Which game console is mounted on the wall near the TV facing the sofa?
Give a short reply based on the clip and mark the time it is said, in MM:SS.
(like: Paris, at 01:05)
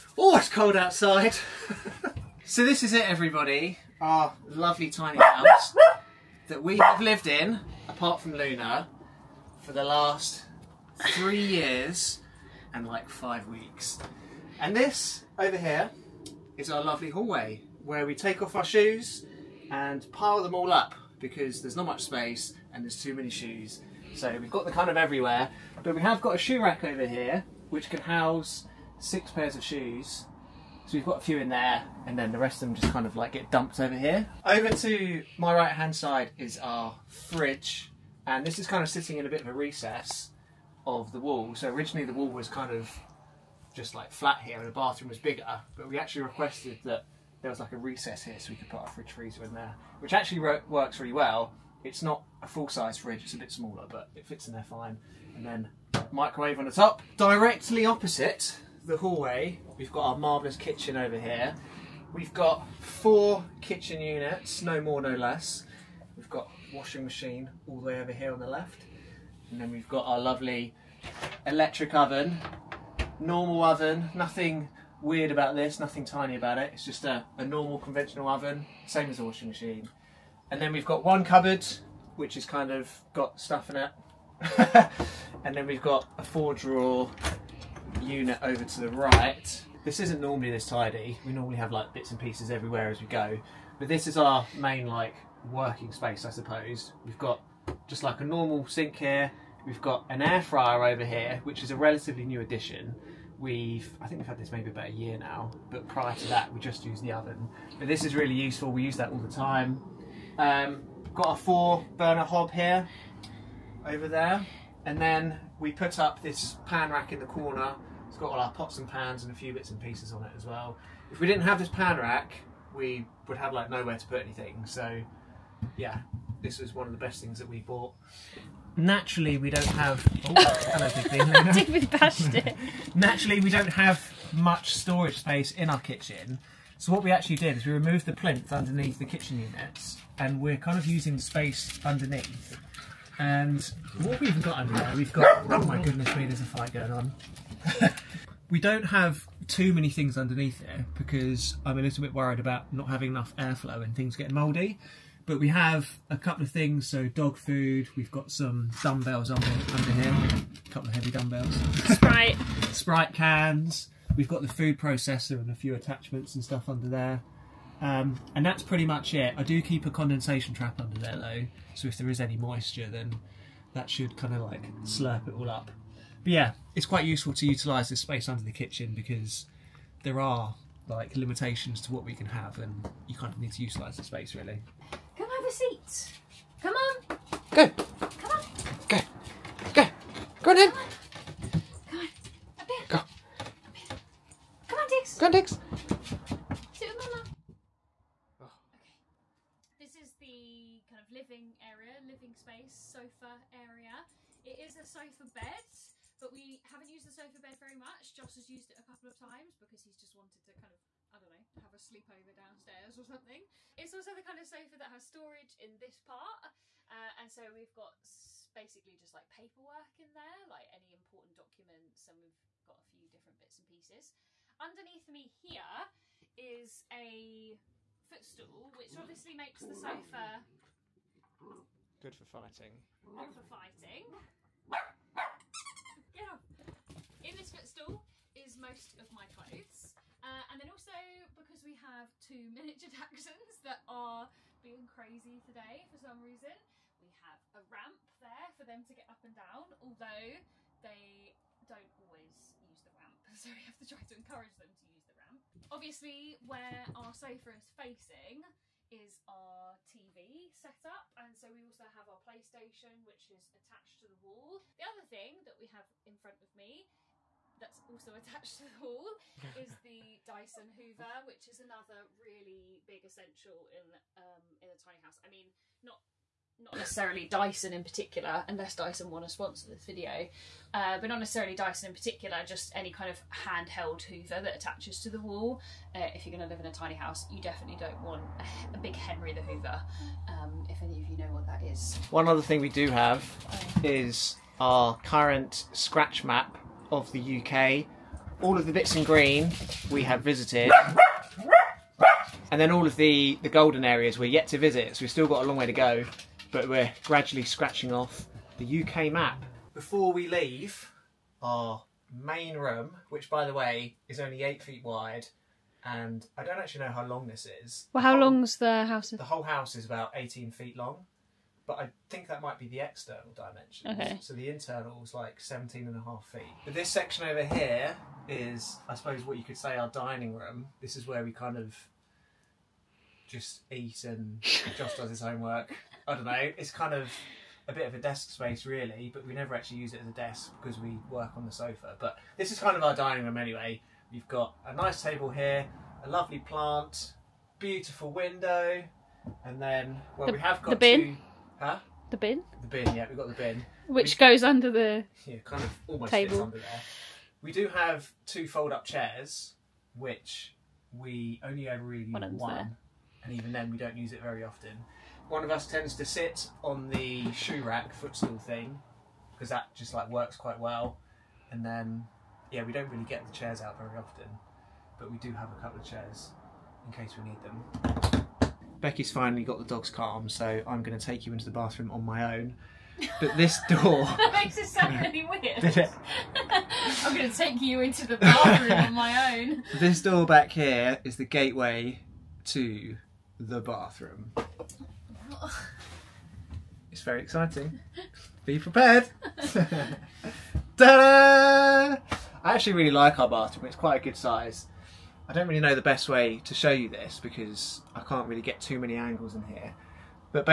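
PlayStation, at 04:22.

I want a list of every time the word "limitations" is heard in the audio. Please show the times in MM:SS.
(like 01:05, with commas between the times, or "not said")
03:01.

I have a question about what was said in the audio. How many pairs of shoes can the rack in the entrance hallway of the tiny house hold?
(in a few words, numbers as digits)
6.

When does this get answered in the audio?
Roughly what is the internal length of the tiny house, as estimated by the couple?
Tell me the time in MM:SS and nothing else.
05:25.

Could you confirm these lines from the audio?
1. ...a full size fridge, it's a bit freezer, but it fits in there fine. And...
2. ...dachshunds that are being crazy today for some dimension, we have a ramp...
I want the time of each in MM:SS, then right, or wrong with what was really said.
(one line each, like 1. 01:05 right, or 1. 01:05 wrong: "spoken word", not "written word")
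1. 00:52 wrong: "smaller", not "freezer"
2. 04:02 wrong: "reason", not "dimension".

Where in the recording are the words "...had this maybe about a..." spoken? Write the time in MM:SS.
01:44.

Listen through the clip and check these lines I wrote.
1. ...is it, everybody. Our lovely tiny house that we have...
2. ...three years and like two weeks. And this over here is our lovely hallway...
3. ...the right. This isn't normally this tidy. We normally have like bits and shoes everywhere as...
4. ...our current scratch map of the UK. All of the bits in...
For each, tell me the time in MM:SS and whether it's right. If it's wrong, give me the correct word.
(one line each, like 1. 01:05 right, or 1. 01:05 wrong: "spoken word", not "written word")
1. 00:02 right
2. 00:11 wrong: "five", not "two"
3. 01:28 wrong: "pieces", not "shoes"
4. 04:54 right.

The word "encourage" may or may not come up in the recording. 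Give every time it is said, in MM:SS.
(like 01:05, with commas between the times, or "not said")
04:14.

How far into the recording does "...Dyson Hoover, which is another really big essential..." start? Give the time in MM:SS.
04:30.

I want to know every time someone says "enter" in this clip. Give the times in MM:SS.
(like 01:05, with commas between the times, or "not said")
not said.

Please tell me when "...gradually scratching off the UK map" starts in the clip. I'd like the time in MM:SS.
05:07.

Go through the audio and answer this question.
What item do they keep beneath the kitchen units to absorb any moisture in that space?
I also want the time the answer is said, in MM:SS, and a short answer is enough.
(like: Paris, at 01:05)
Condensation trap, at 02:49.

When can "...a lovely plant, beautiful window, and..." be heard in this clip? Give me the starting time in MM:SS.
05:46.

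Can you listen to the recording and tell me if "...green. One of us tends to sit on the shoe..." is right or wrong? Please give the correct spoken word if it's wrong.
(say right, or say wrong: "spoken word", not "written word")
wrong: "often", not "green".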